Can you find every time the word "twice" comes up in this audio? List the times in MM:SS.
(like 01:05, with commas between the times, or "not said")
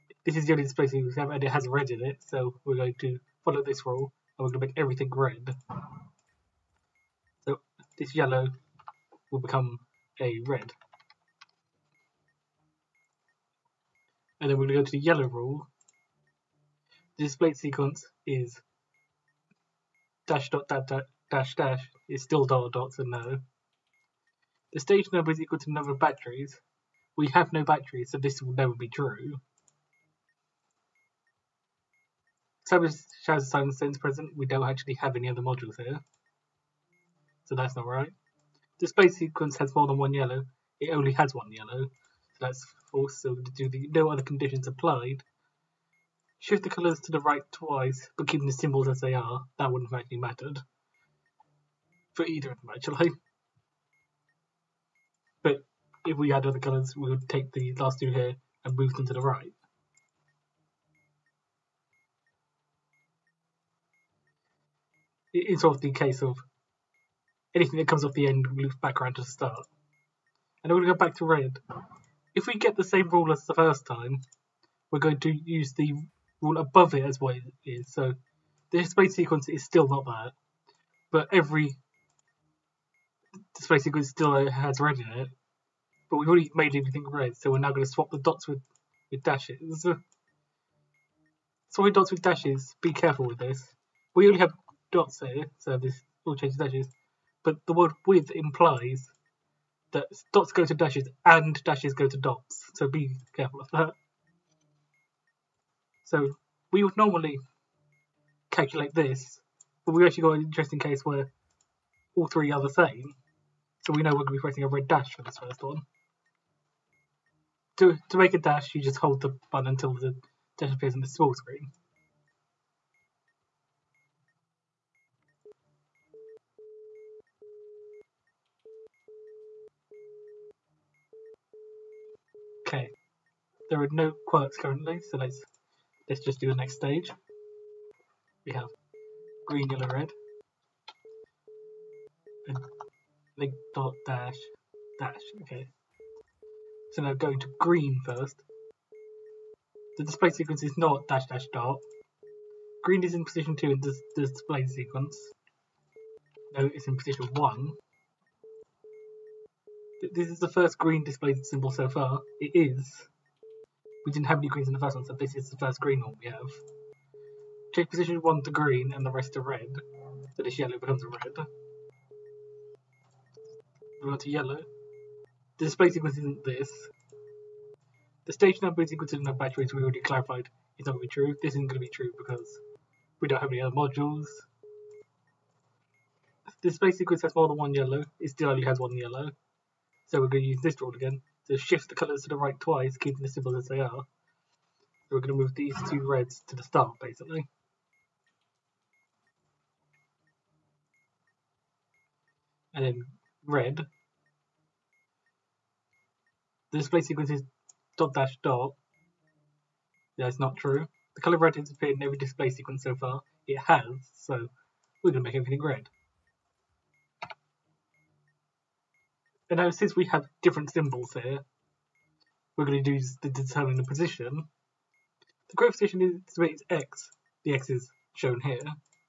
00:47, 03:12.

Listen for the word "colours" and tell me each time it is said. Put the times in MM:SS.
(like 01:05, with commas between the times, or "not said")
00:46, 00:56, 03:11, 03:31.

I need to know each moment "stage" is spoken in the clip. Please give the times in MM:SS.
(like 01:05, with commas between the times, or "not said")
00:24, 02:16, 02:58.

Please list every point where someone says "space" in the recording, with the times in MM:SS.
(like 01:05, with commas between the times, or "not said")
01:18, 01:23.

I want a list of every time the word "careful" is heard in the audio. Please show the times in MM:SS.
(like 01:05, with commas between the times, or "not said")
01:32, 01:43.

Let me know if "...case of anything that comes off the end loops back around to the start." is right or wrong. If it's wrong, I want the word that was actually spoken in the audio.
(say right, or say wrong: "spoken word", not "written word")
right.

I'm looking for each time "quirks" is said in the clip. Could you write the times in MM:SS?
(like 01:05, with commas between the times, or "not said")
02:14.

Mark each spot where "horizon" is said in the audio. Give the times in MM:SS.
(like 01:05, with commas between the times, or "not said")
not said.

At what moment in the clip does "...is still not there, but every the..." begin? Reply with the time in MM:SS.
01:19.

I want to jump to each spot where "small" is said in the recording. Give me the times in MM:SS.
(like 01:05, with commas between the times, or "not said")
02:01.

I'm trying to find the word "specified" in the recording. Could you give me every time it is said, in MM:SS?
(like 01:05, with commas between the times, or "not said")
not said.